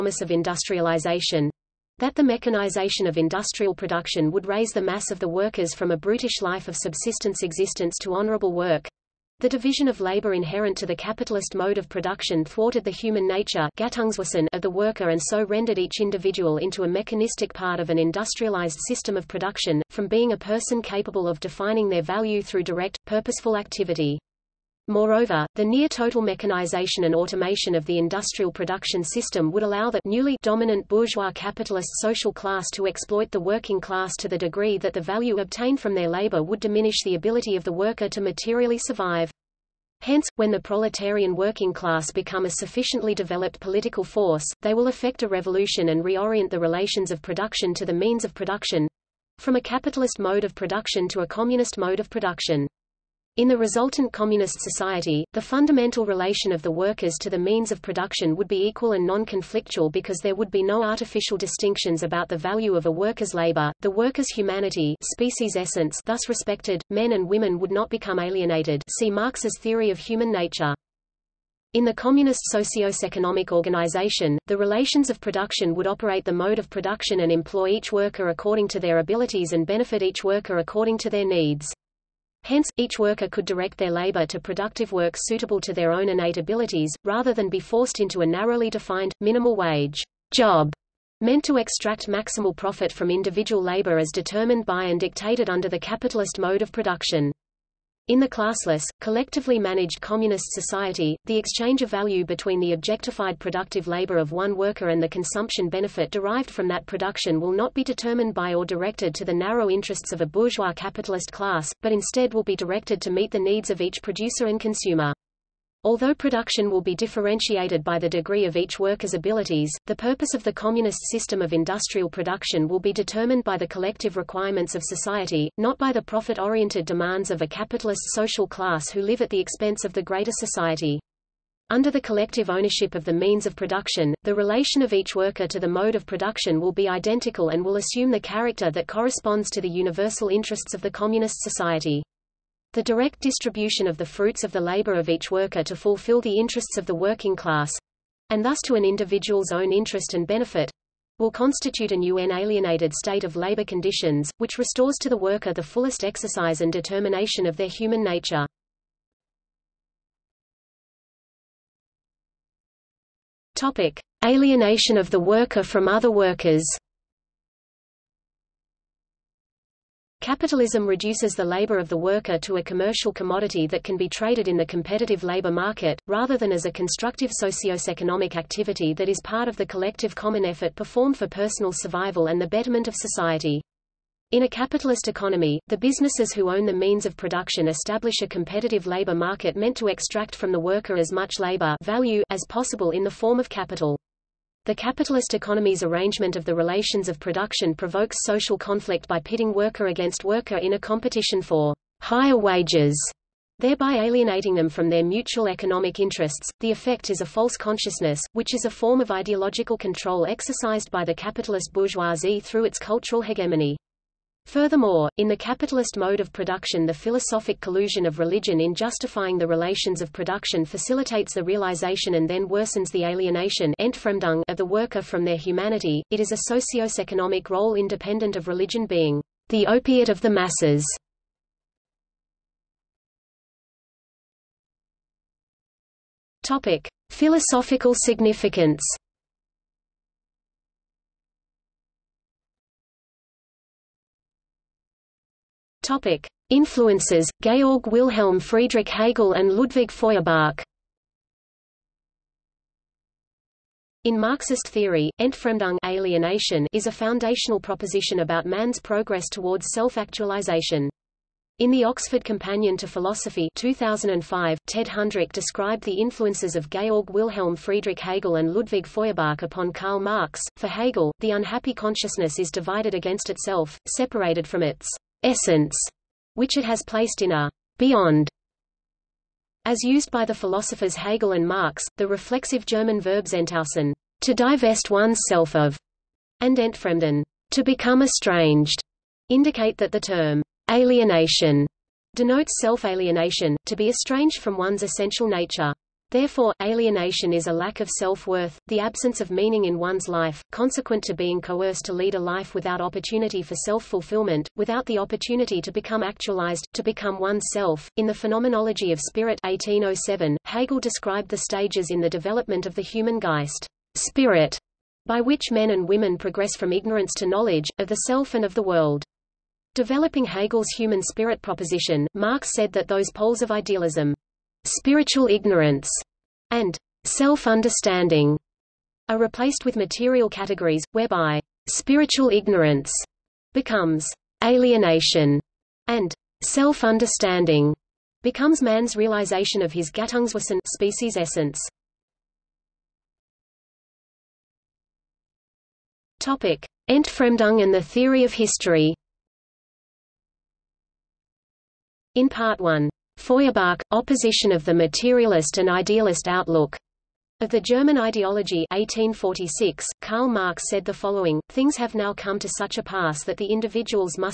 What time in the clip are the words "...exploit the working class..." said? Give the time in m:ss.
0:32.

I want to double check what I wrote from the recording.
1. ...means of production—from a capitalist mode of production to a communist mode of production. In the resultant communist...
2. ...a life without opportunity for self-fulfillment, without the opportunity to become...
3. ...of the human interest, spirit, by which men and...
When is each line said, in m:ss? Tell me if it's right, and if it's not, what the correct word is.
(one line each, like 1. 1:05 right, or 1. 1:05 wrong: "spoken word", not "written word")
1. 0:47 right
2. 5:02 right
3. 5:12 wrong: "geist", not "interest".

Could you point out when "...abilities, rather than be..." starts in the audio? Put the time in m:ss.
1:26.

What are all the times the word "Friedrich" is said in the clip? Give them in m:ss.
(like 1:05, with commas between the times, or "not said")
4:08, 4:27.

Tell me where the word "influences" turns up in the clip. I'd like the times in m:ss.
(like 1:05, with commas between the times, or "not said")
4:06, 4:26.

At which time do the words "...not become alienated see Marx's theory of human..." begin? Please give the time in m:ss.
1:07.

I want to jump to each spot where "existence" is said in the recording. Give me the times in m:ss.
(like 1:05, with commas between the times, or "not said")
0:07.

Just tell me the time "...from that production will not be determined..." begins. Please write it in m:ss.
1:46.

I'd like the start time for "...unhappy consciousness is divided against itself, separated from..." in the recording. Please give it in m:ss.
4:31.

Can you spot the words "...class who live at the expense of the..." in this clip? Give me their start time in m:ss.
2:08.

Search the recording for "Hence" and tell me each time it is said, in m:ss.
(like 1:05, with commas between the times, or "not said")
0:40, 1:22.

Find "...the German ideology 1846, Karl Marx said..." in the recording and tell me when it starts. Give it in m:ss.
5:57.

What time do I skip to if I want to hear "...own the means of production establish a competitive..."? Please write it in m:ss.
3:06.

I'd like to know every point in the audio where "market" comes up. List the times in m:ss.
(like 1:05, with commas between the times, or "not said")
2:55, 3:09.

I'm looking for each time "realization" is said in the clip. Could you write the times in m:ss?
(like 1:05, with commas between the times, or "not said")
3:41, 5:38.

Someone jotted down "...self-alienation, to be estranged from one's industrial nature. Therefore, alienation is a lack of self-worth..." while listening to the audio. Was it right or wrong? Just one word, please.
wrong.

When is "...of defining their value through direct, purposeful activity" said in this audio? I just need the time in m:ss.
0:21.